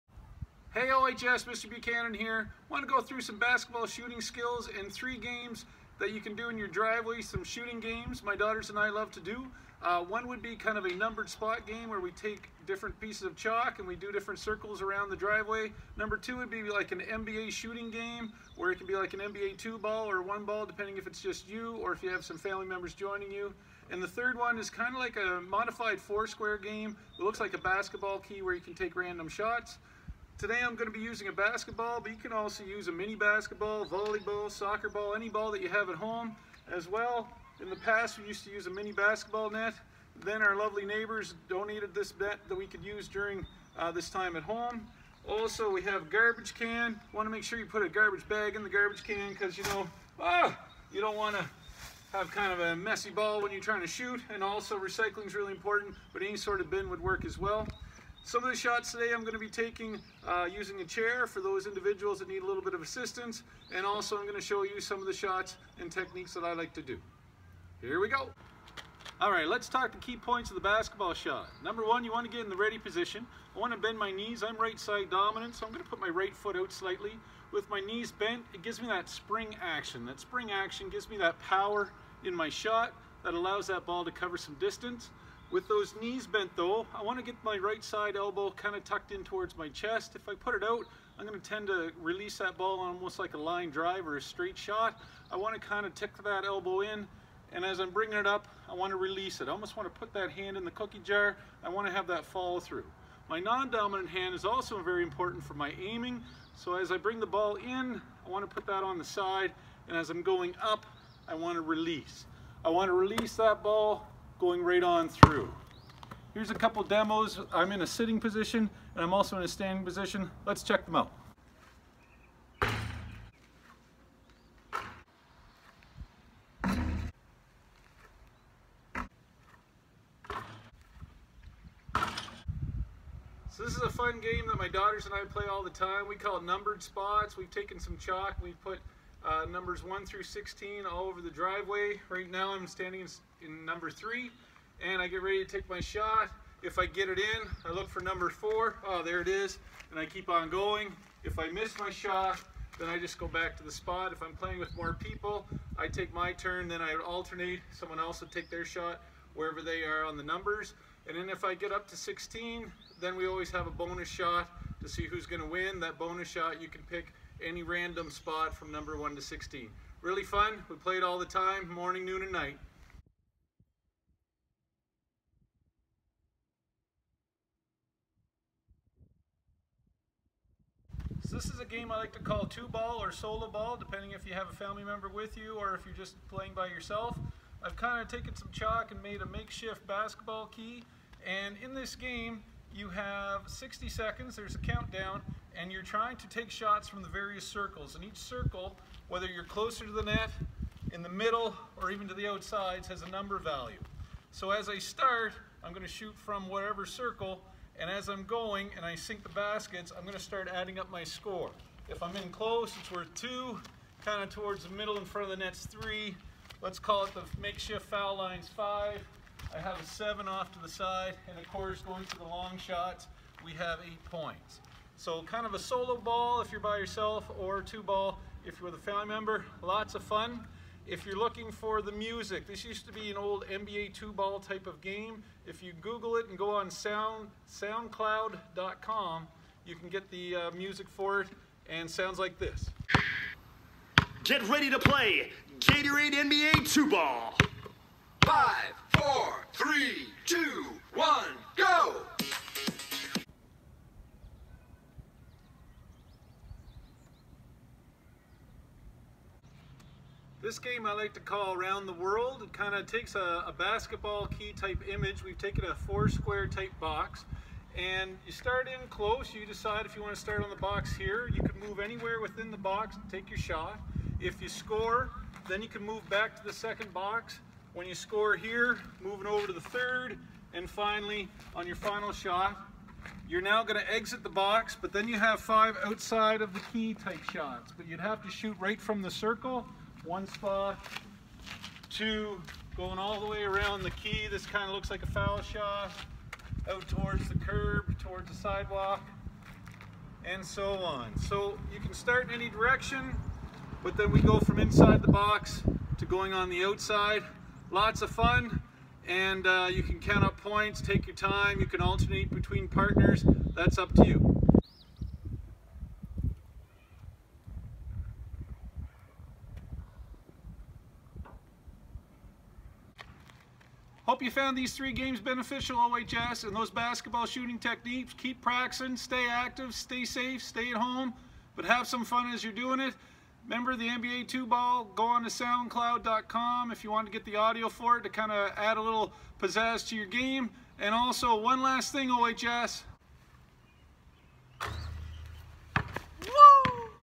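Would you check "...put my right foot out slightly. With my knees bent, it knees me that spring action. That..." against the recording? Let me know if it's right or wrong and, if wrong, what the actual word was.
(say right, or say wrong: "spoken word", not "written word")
wrong: "gives", not "knees".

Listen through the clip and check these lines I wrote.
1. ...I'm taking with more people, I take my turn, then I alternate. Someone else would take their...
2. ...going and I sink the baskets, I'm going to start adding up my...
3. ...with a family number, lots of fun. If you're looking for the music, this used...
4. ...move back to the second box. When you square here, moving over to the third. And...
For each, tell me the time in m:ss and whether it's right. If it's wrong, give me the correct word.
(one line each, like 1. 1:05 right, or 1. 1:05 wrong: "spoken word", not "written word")
1. 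2:34 wrong: "playing", not "taking"
2. 3:28 right
3. 3:48 wrong: "member", not "number"
4. 4:35 wrong: "score", not "square".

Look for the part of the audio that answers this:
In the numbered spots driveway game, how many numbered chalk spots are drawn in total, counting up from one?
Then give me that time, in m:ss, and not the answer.
2:19.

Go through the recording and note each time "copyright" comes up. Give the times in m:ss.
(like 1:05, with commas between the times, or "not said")
not said.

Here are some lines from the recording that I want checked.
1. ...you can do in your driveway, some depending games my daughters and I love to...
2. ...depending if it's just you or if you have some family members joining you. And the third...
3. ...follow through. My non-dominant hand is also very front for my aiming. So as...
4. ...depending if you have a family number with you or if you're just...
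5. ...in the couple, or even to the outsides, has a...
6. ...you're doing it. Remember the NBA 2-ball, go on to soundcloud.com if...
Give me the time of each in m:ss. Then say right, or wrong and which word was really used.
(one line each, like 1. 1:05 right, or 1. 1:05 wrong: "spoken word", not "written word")
1. 0:06 wrong: "shooting", not "depending"
2. 0:20 right
3. 1:42 wrong: "important", not "front"
4. 3:03 wrong: "member", not "number"
5. 3:20 wrong: "middle", not "couple"
6. 5:32 right.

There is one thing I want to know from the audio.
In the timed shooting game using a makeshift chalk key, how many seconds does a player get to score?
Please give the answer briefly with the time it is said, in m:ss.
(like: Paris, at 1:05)
60, at 3:13.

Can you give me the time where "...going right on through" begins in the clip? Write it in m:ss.
1:54.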